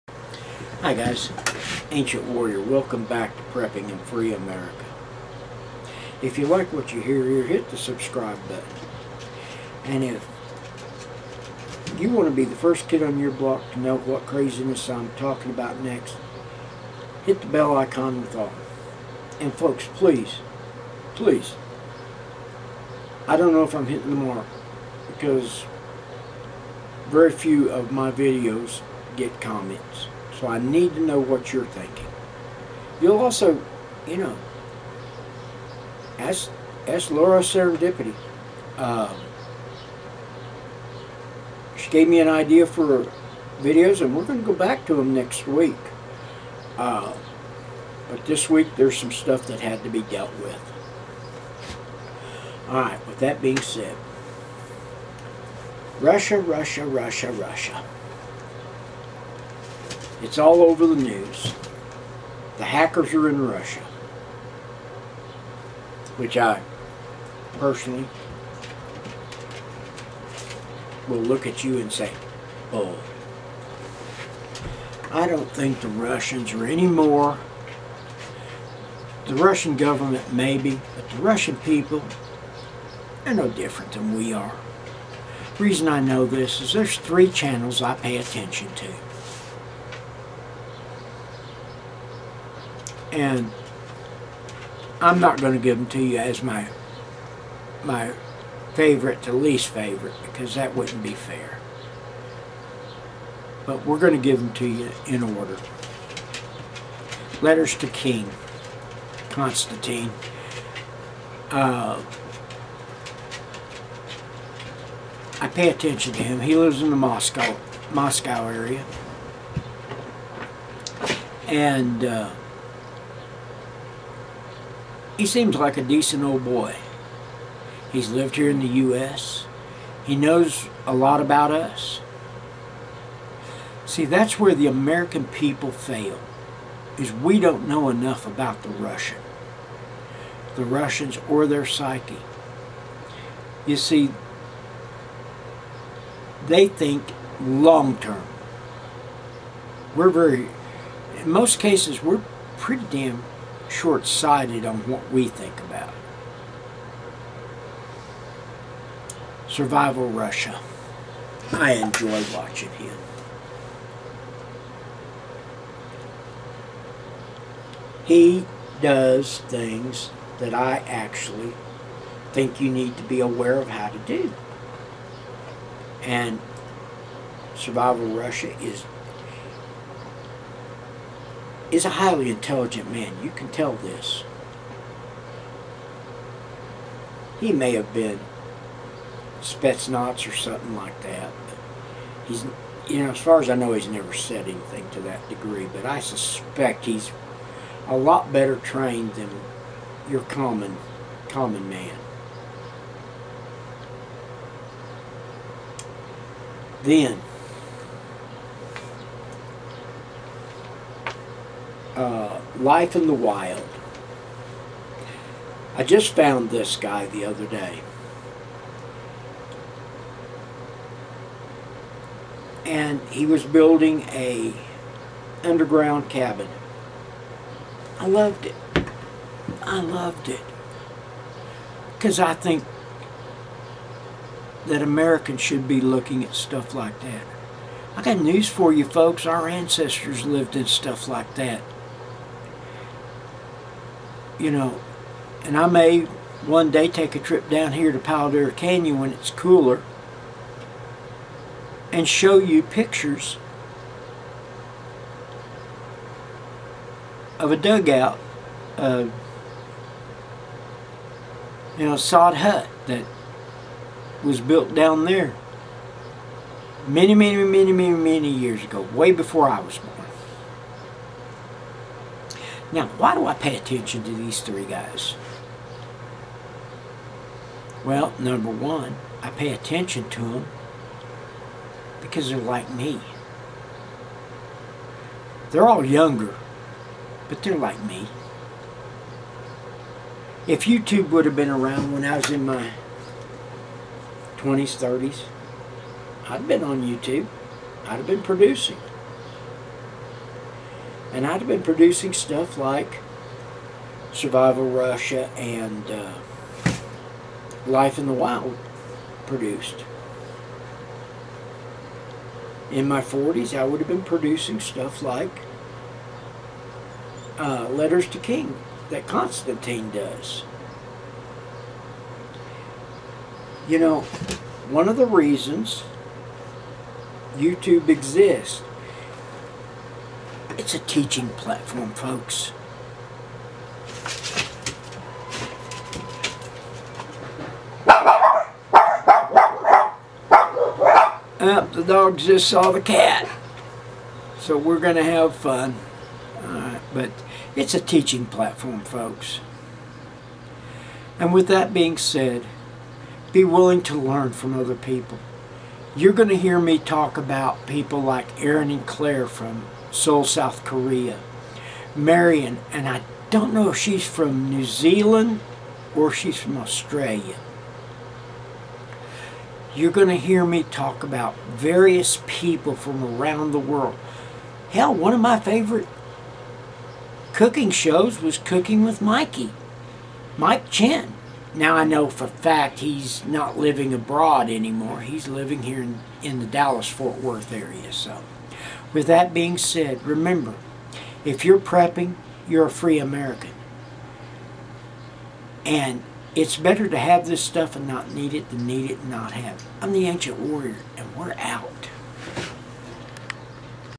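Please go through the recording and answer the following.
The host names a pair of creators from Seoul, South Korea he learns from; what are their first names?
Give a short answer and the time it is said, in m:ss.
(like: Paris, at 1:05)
Aaron and Claire, at 5:58.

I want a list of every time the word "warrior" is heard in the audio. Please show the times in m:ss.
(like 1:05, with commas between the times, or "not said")
0:02, 6:40.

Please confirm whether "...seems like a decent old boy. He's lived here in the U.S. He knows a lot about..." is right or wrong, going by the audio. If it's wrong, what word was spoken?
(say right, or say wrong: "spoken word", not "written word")
right.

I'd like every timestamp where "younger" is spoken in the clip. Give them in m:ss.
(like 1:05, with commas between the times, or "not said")
4:45.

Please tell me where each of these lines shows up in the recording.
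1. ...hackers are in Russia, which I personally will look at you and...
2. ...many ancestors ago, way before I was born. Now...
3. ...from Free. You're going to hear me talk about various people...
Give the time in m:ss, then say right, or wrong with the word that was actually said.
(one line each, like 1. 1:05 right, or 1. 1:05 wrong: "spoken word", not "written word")
1. 1:02 right
2. 4:27 wrong: "years", not "ancestors"
3. 6:06 wrong: "Australia", not "Free".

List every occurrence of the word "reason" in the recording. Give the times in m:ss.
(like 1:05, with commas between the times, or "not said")
1:25, 5:25.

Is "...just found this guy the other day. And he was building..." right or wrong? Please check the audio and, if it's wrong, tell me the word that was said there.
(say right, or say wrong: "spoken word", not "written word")
right.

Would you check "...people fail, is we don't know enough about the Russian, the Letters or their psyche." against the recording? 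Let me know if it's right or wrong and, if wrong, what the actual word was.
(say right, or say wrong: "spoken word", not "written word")
wrong: "Russians", not "Letters".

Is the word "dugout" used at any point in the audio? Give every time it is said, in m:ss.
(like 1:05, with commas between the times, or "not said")
4:17.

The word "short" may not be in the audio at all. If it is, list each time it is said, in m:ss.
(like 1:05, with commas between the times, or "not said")
2:33.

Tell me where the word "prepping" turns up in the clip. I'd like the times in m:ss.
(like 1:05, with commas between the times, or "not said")
0:03, 6:31.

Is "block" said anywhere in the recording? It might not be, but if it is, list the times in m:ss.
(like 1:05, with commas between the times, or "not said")
0:13.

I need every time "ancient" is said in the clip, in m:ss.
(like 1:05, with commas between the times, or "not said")
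0:01, 6:40.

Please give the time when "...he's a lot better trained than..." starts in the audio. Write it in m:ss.
3:16.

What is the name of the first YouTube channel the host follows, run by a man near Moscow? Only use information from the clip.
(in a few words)
Letters to King Constantine.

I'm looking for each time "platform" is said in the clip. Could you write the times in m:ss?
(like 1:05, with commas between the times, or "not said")
5:31, 5:48.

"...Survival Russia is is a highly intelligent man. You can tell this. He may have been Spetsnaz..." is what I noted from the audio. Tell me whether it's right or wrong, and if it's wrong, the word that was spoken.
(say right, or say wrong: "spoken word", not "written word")
right.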